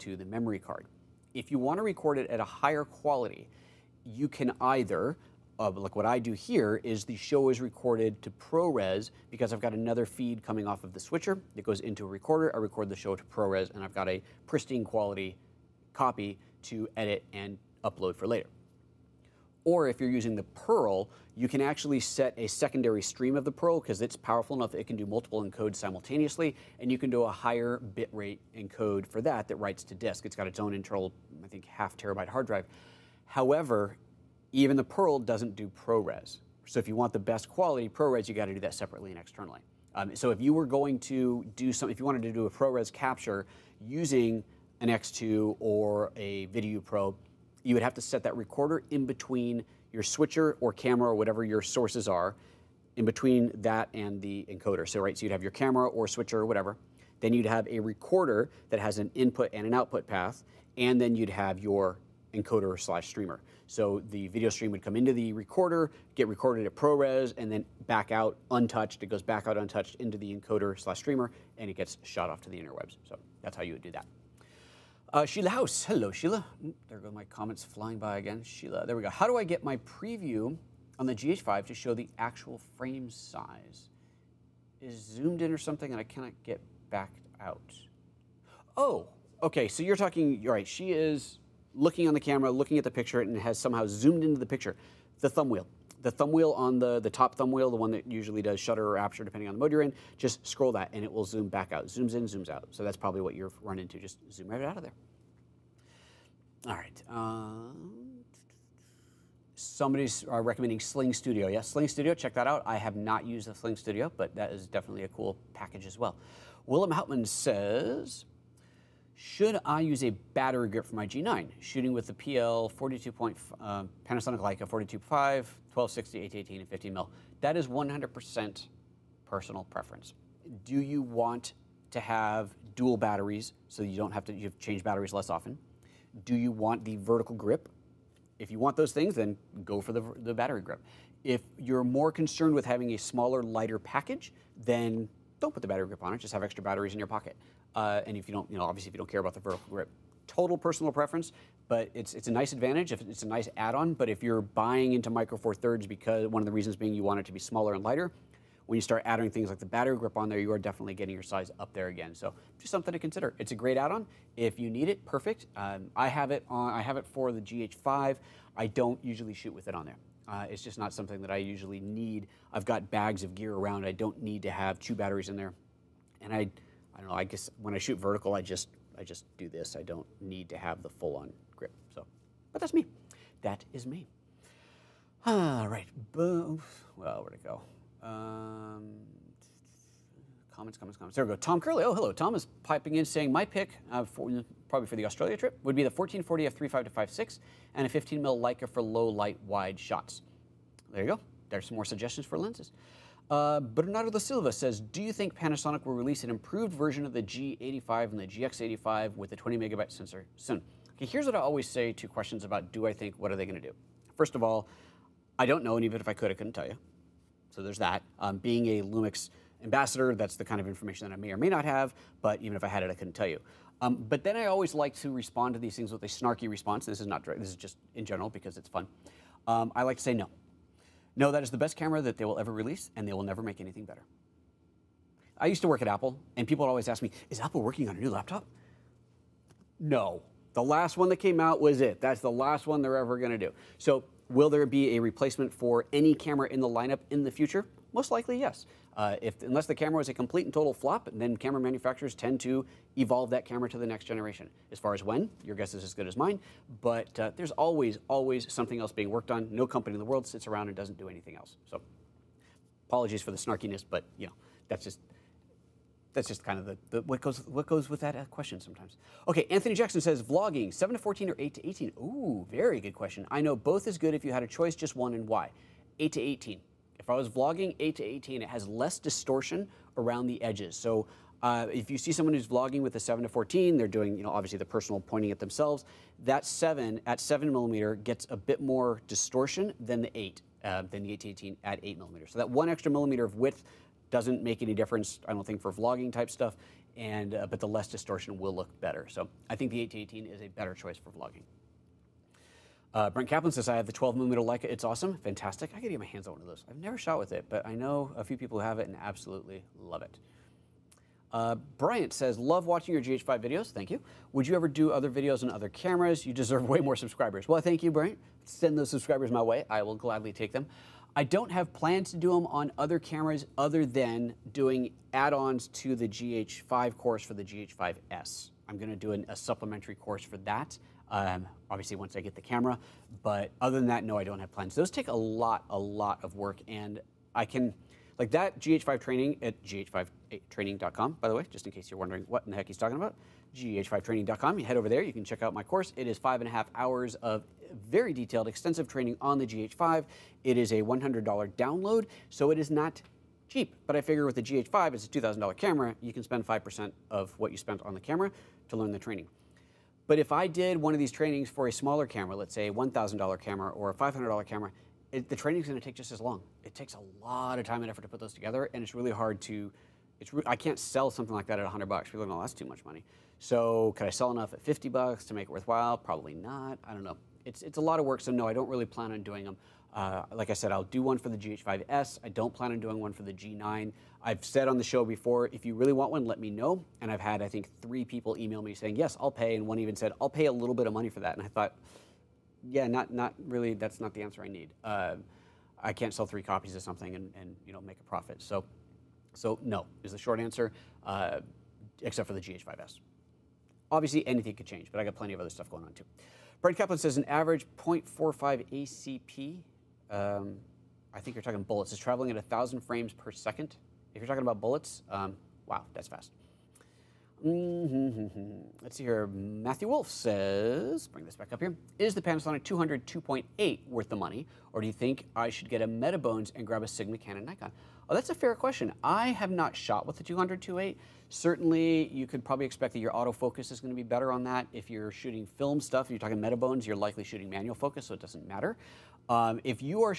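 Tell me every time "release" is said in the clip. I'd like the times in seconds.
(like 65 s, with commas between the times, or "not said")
205 s, 232 s.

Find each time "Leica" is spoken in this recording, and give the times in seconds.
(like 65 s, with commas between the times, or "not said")
124 s, 198 s, 304 s.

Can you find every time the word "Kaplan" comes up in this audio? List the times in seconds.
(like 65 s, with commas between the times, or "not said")
303 s, 406 s.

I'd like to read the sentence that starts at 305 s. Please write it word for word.
I could get my hands on one of those.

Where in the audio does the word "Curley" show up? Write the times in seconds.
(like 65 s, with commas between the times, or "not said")
191 s.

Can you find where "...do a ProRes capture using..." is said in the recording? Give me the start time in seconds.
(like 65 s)
42 s.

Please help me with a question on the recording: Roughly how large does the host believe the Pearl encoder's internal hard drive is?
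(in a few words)
half terabyte.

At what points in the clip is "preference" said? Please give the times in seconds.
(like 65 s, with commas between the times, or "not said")
129 s, 150 s.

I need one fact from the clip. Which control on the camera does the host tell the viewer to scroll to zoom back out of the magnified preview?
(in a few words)
top thumb wheel.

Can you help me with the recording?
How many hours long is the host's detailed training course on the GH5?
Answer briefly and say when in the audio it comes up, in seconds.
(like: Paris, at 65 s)
5 and a half, at 346 s.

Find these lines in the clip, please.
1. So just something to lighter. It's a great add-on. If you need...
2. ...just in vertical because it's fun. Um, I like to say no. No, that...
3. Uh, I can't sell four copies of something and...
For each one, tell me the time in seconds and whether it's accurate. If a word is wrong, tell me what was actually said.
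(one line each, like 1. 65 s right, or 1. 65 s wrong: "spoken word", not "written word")
1. 162 s wrong: "consider", not "lighter"
2. 227 s wrong: "general", not "vertical"
3. 394 s wrong: "three", not "four".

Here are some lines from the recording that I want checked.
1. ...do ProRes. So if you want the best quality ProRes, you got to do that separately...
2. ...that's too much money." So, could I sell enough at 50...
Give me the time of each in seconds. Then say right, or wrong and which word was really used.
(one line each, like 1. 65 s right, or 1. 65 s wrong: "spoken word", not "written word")
1. 35 s right
2. 372 s right.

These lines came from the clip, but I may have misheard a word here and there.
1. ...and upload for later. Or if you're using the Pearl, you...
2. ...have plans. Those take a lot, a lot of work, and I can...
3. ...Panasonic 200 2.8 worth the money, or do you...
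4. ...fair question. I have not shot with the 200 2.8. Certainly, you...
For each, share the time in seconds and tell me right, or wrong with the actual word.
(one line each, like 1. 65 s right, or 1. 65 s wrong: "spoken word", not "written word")
1. 17 s right
2. 334 s right
3. 422 s right
4. 428 s right.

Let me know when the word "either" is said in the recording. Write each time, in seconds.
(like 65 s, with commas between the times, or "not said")
4 s.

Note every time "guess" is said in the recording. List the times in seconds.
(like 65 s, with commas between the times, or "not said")
177 s, 255 s.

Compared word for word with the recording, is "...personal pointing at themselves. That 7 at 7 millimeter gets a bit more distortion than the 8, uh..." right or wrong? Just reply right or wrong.
right.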